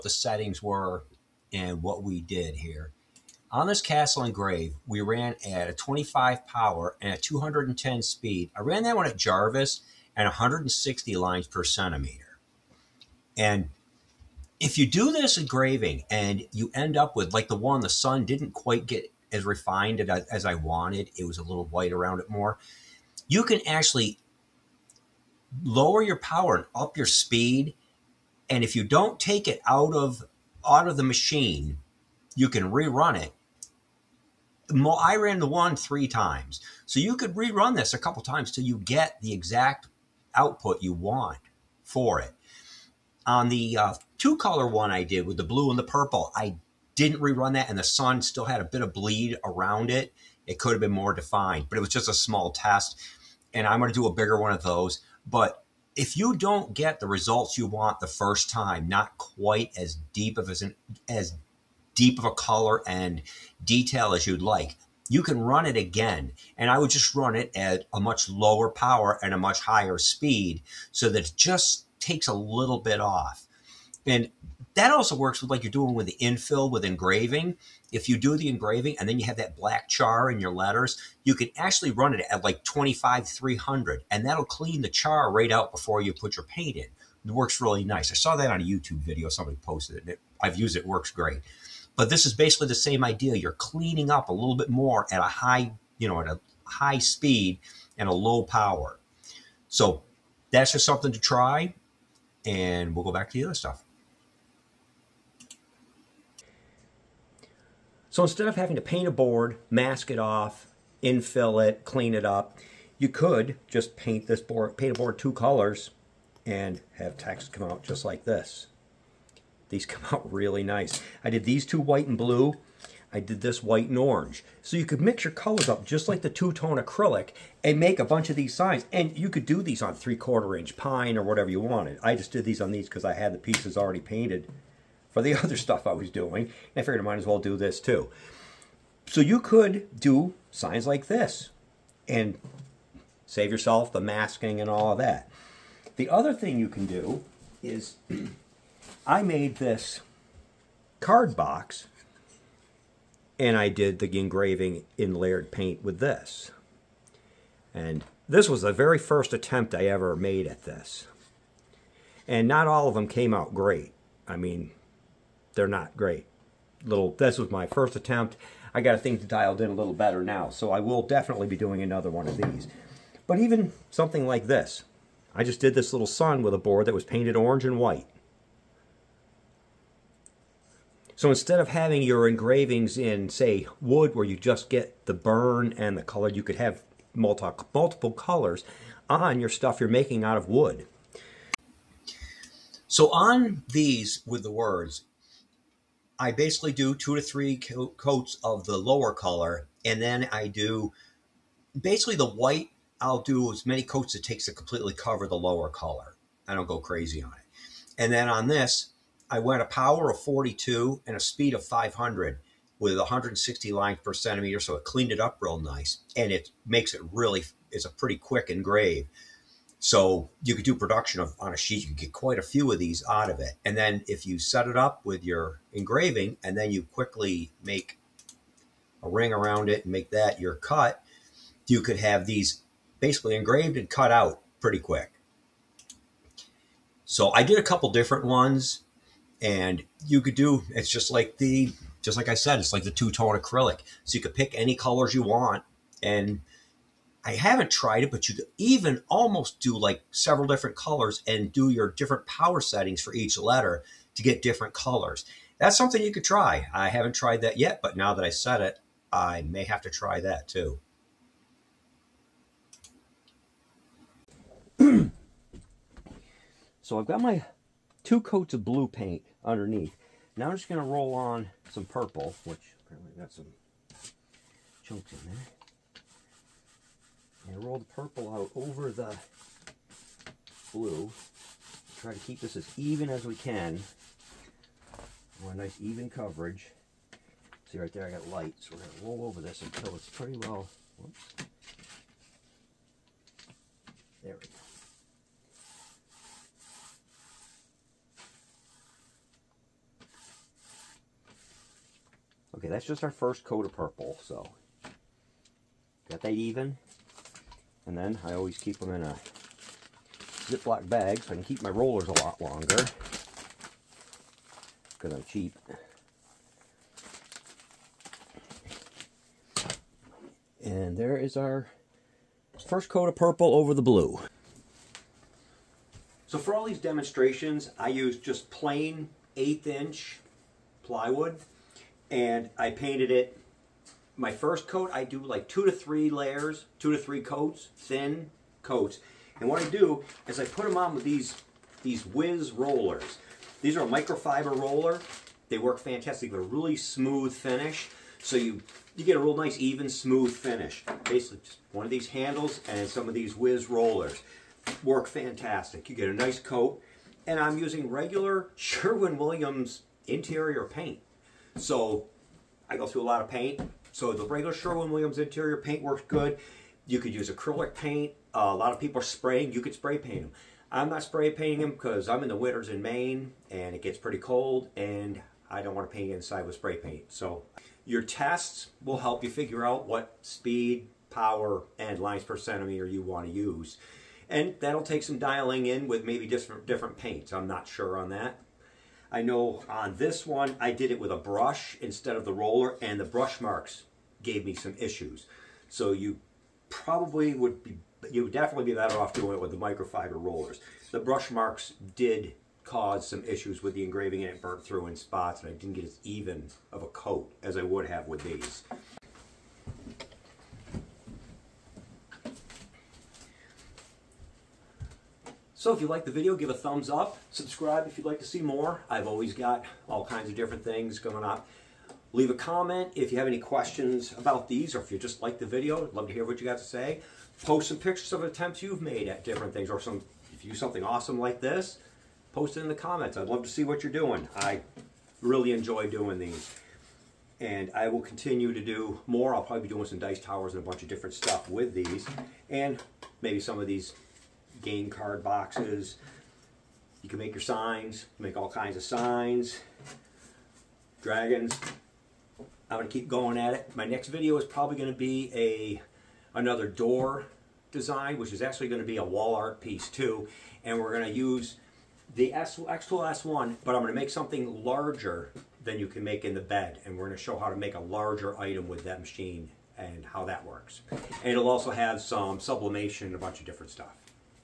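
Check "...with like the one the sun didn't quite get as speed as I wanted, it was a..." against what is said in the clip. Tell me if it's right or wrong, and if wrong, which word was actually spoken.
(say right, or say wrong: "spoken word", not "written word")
wrong: "refined", not "speed".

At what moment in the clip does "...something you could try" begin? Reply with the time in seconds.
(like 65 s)
255 s.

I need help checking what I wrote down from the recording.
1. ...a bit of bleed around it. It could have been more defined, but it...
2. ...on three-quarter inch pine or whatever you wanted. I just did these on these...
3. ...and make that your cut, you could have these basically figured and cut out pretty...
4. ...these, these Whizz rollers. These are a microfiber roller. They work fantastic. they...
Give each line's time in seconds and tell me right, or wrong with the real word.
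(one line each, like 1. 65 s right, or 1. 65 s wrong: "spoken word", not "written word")
1. 48 s right
2. 129 s right
3. 229 s wrong: "engraved", not "figured"
4. 341 s right.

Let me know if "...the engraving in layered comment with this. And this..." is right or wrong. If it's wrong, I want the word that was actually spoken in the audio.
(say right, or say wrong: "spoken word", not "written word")
wrong: "paint", not "comment".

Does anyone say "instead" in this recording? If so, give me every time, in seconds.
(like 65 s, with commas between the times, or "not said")
108 s, 181 s, 391 s.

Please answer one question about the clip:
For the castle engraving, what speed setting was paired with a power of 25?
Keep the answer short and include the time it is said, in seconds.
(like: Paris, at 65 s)
210, at 7 s.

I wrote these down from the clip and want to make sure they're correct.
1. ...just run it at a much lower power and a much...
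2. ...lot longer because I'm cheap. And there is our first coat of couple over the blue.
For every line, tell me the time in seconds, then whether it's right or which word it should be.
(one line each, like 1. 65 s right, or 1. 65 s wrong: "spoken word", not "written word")
1. 66 s right
2. 312 s wrong: "purple", not "couple".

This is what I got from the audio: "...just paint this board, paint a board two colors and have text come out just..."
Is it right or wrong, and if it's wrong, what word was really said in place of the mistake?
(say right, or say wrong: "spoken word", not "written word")
right.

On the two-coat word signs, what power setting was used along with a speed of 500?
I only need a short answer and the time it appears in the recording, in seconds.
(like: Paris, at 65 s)
42, at 210 s.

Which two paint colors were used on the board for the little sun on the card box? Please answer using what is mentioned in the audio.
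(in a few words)
orange and white.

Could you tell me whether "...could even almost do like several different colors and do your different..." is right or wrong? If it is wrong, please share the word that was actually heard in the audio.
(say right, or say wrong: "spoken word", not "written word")
right.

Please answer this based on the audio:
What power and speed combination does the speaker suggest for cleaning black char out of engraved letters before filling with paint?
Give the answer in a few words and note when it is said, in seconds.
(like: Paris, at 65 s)
25, 300, at 82 s.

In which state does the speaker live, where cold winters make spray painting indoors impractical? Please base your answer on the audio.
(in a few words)
Maine.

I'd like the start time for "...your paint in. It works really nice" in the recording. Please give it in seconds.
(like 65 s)
86 s.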